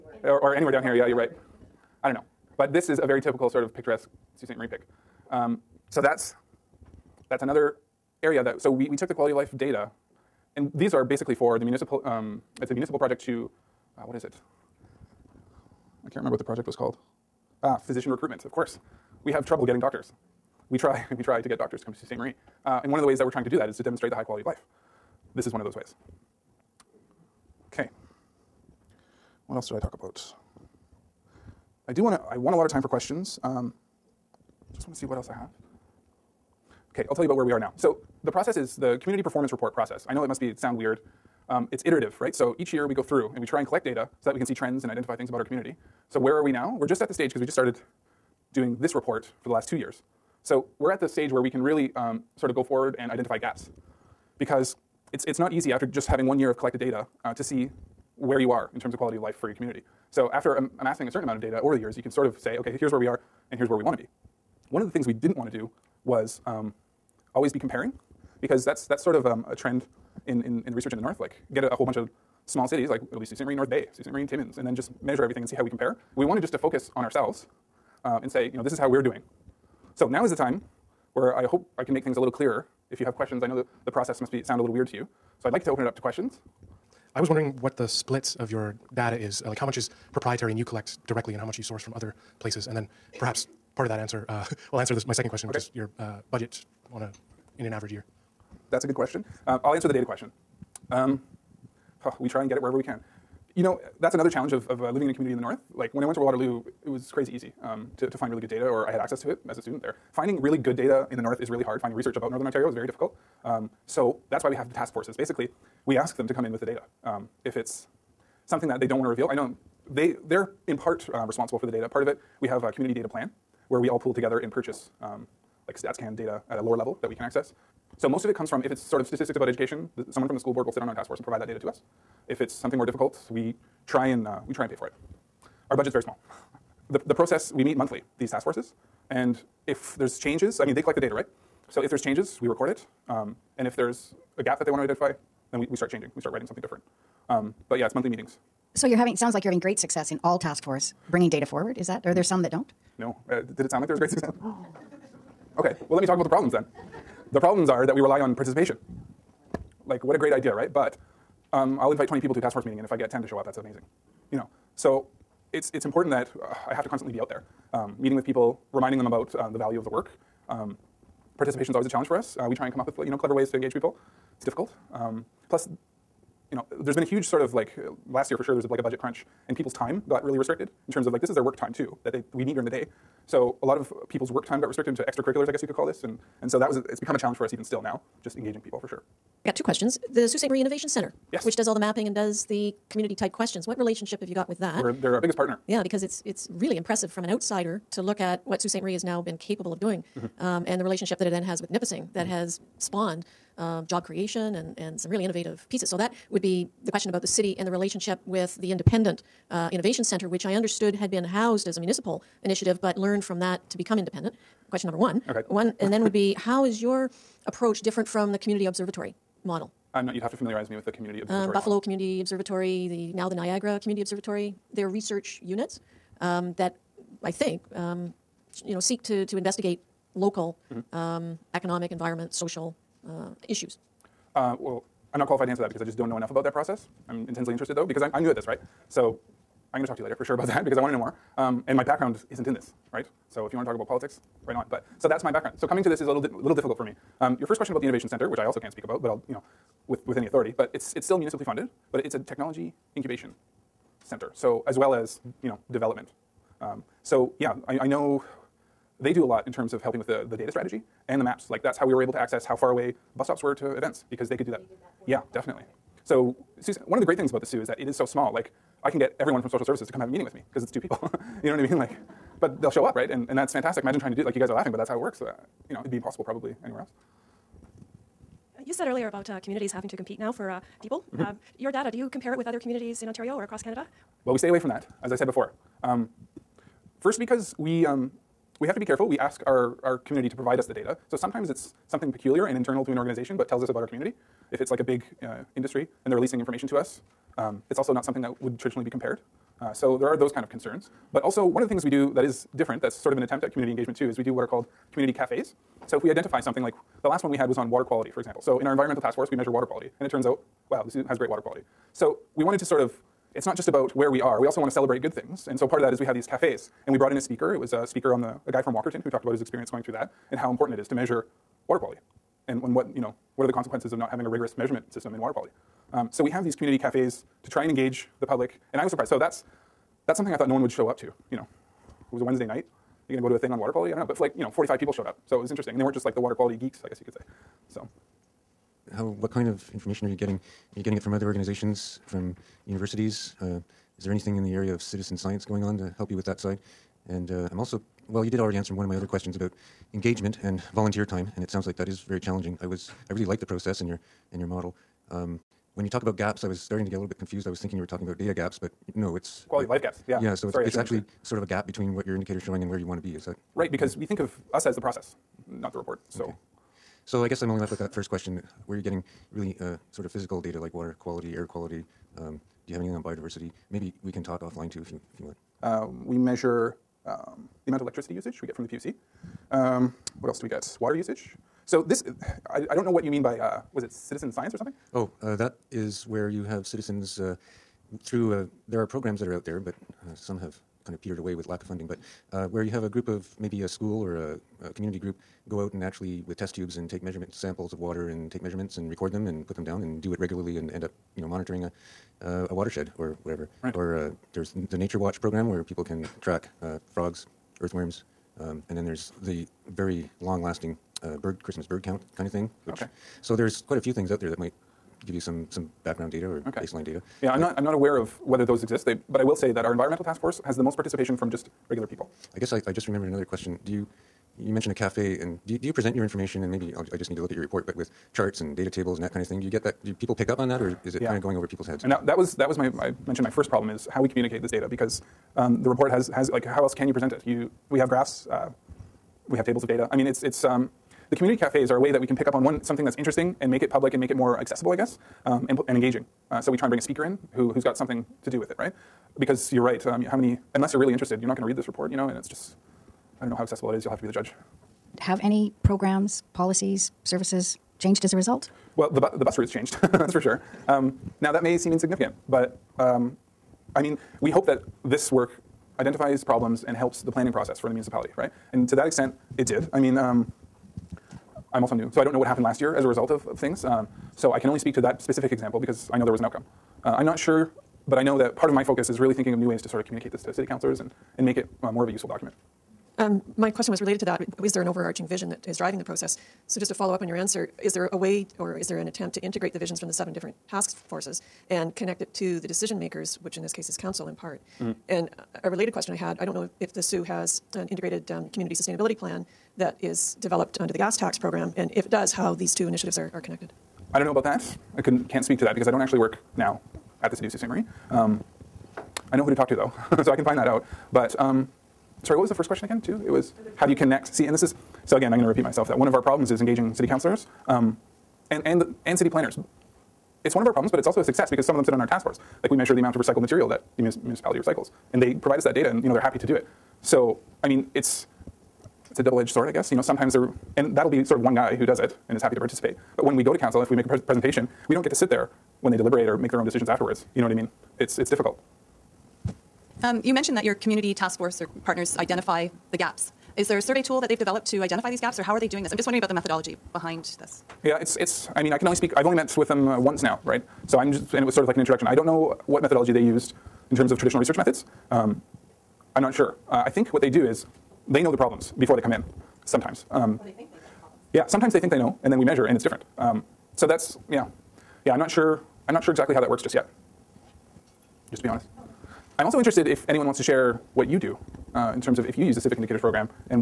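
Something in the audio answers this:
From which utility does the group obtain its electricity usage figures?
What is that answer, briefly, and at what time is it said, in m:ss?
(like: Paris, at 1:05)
PUC, at 6:18.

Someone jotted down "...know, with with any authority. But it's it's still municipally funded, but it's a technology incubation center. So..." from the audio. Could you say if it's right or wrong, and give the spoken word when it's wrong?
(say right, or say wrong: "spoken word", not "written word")
right.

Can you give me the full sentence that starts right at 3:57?
I'm intensely interested though because I'm I'm new at this, right?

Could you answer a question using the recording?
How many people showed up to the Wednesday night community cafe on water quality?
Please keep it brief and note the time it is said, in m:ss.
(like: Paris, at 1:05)
45, at 5:34.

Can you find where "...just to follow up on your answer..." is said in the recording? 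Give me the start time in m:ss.
8:06.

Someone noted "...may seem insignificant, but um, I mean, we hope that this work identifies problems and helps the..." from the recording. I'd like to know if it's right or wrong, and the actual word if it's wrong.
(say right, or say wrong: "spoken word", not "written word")
right.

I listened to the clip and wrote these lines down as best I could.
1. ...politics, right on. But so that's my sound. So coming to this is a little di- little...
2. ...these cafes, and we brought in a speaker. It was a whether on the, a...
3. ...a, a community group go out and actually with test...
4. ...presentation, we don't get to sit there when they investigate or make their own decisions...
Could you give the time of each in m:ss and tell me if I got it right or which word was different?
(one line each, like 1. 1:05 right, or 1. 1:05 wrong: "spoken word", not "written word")
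1. 4:03 wrong: "background", not "sound"
2. 5:16 wrong: "speaker", not "whether"
3. 6:34 right
4. 8:53 wrong: "deliberate", not "investigate".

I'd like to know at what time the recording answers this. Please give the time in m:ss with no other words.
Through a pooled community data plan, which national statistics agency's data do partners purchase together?
2:05.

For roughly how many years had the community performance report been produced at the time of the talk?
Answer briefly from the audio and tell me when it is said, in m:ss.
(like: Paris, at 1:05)
2, at 0:49.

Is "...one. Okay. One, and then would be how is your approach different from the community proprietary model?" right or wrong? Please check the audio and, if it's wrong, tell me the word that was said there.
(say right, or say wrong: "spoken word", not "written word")
wrong: "observatory", not "proprietary".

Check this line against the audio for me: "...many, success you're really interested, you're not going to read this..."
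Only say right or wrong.
wrong.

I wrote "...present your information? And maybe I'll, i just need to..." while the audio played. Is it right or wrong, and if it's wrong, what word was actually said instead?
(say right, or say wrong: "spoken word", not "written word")
right.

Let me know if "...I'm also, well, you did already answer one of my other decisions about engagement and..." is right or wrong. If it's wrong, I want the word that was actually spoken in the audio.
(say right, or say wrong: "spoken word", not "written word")
wrong: "questions", not "decisions".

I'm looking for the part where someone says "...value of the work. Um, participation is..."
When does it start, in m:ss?
2:49.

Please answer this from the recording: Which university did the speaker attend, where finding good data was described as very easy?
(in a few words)
Waterloo.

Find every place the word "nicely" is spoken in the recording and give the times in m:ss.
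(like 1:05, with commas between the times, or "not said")
not said.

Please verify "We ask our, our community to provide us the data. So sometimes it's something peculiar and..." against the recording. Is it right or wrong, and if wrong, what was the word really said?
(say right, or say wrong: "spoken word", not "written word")
right.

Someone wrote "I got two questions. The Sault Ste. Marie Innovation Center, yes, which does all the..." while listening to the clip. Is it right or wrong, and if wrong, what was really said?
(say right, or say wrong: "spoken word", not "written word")
right.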